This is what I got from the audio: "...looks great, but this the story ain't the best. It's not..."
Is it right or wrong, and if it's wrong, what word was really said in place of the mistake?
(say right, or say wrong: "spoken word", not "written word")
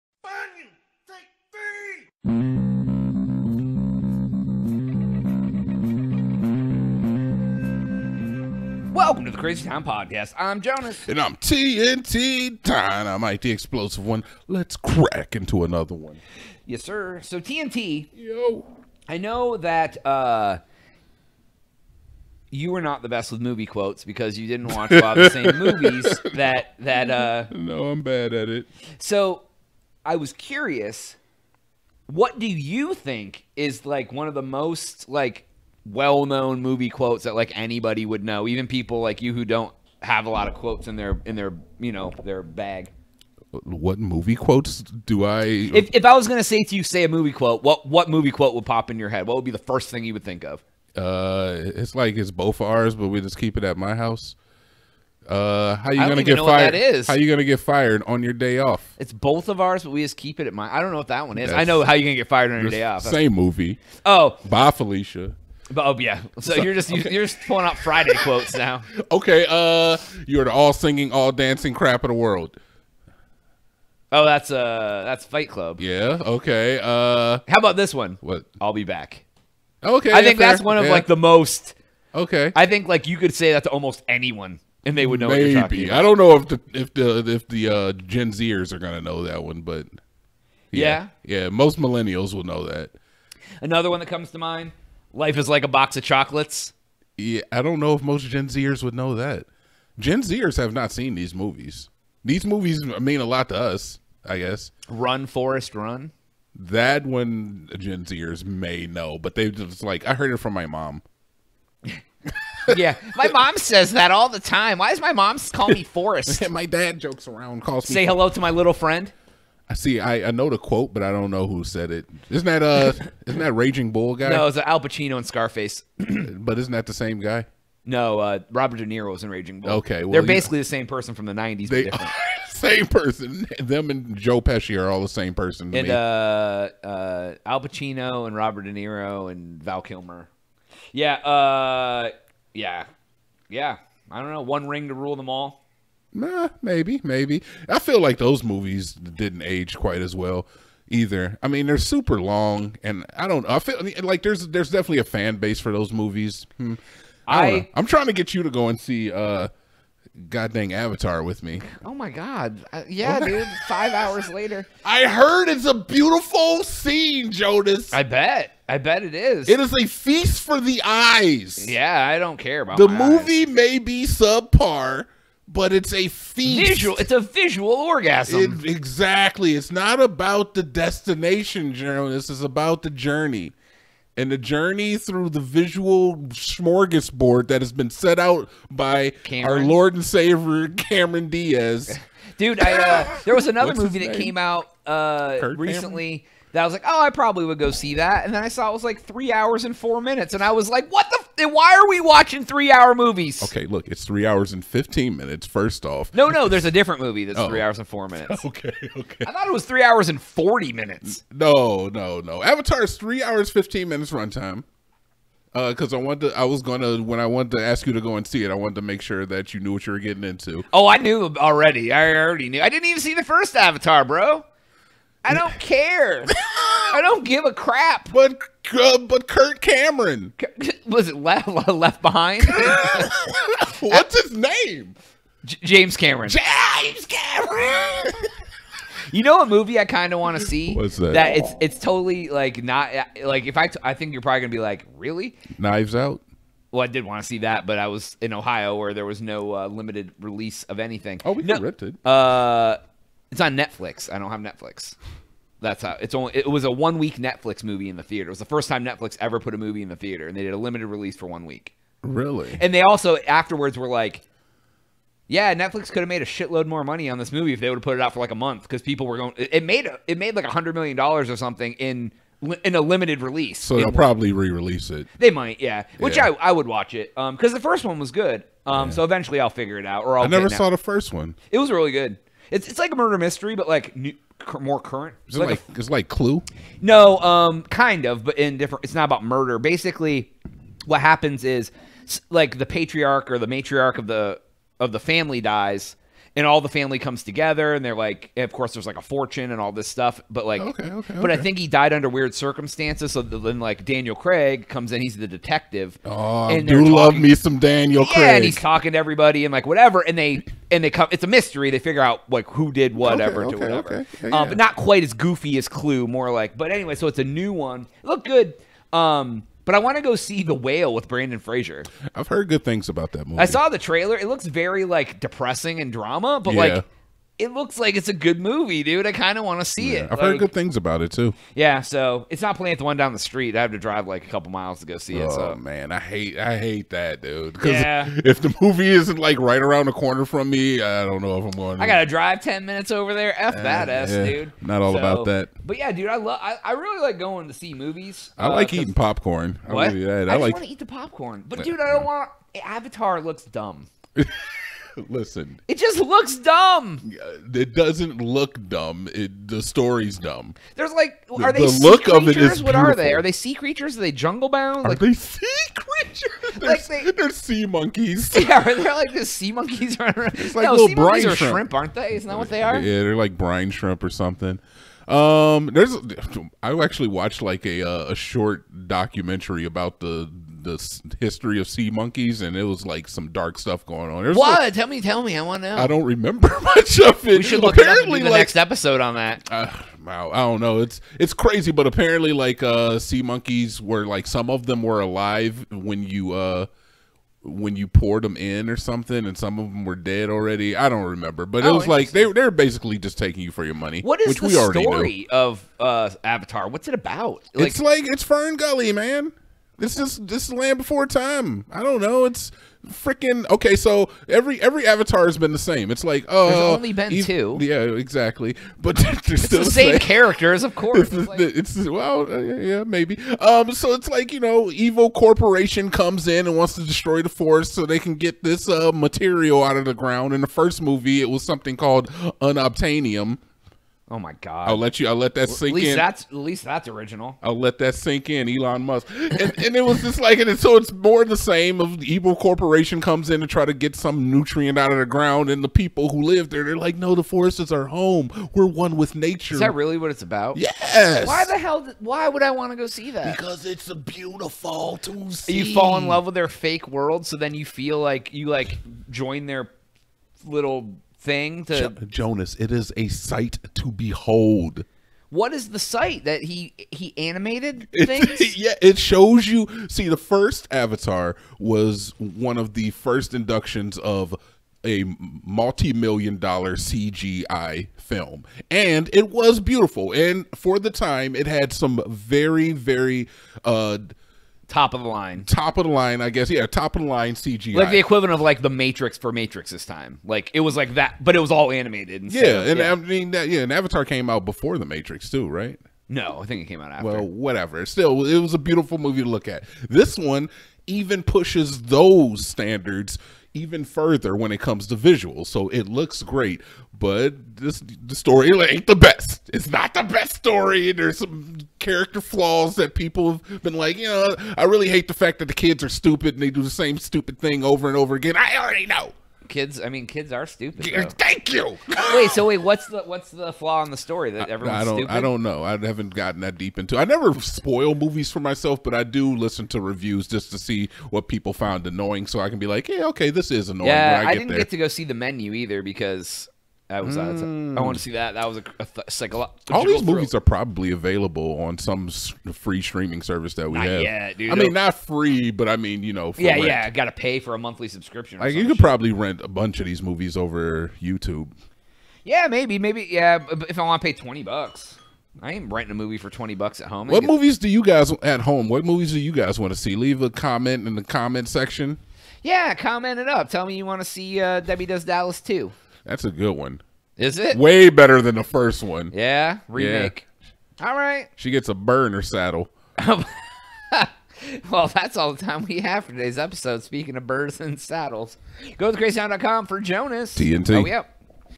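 right.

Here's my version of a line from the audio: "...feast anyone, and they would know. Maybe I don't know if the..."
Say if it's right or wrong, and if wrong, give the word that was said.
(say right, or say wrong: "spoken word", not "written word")
wrong: "almost", not "feast".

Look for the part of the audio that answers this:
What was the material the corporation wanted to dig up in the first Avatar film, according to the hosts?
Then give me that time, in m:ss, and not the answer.
7:12.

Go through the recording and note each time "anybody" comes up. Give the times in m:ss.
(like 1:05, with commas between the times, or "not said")
0:37.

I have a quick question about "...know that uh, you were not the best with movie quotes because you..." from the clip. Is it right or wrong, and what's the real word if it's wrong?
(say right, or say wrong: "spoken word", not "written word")
right.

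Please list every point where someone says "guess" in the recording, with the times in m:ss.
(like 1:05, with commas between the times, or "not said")
1:44, 8:06.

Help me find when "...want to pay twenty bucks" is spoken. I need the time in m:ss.
9:13.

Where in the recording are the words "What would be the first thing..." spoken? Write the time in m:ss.
0:49.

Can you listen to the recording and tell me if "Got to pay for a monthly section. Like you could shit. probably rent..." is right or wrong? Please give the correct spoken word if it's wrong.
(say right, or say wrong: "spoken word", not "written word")
wrong: "subscription", not "section".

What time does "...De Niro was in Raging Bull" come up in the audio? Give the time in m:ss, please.
2:08.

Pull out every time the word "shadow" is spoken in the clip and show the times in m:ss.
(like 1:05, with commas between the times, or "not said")
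not said.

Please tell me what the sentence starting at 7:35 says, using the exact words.
You fall in love with their fake world, so then you feel like you like join their little thing to jo- Jonas.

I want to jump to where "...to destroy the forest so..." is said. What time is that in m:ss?
7:06.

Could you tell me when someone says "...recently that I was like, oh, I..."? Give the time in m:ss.
3:15.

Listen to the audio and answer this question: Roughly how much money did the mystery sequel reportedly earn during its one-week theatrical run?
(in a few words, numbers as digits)
$100 million.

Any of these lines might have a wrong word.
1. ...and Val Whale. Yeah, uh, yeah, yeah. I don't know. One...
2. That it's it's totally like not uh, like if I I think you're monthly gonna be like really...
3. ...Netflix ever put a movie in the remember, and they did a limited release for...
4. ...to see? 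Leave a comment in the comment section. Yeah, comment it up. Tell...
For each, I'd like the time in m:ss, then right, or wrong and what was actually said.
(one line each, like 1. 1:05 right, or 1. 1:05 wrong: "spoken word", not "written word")
1. 2:19 wrong: "Kilmer", not "Whale"
2. 4:01 wrong: "probably", not "monthly"
3. 4:18 wrong: "theater", not "remember"
4. 9:19 right.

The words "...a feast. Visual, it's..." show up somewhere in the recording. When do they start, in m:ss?
2:55.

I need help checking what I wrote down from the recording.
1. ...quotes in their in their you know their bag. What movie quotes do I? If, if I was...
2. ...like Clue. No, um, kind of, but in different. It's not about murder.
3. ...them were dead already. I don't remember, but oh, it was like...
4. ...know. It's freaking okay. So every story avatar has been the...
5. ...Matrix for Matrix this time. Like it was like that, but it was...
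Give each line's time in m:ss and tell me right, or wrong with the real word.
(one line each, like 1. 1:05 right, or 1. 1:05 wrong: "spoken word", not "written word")
1. 0:40 right
2. 4:45 right
3. 6:39 right
4. 6:52 wrong: "every", not "story"
5. 8:08 right.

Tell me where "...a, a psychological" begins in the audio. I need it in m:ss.
8:58.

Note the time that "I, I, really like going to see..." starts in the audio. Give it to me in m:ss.
5:46.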